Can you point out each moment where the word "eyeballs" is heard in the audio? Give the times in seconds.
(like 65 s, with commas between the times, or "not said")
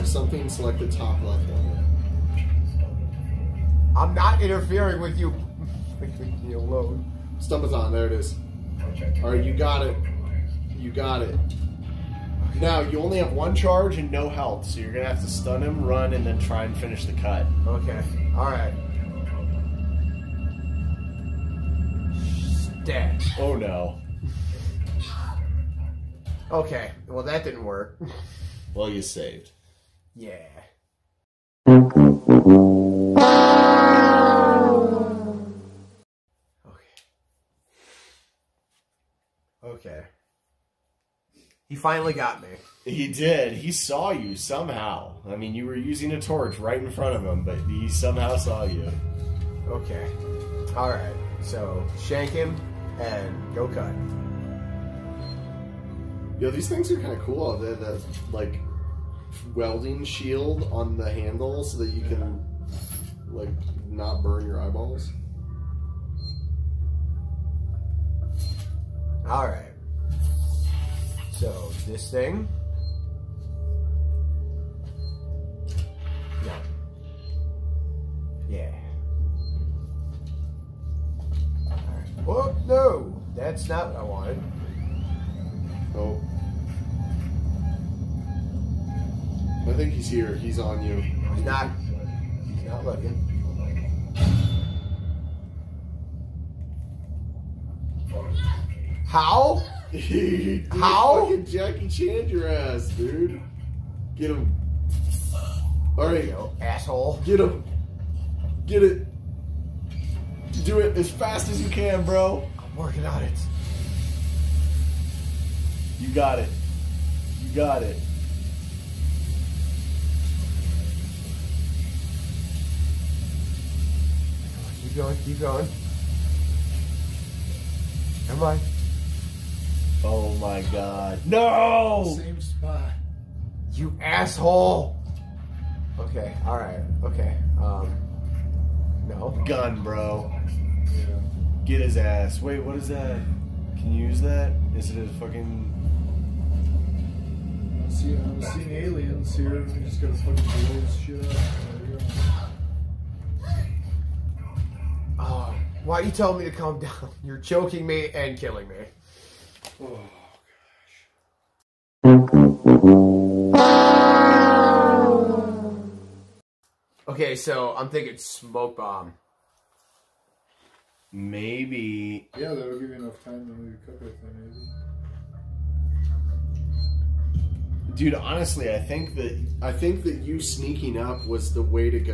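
64 s.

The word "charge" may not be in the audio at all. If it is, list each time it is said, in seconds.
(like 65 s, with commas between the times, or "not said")
13 s.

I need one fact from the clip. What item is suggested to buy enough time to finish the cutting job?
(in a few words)
smoke bomb.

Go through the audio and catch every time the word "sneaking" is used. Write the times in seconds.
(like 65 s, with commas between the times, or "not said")
180 s.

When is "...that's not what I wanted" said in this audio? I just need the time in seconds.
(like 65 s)
83 s.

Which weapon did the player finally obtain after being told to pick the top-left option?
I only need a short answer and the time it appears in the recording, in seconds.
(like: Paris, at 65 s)
stun baton, at 7 s.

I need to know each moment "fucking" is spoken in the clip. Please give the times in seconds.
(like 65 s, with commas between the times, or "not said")
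101 s, 145 s, 150 s.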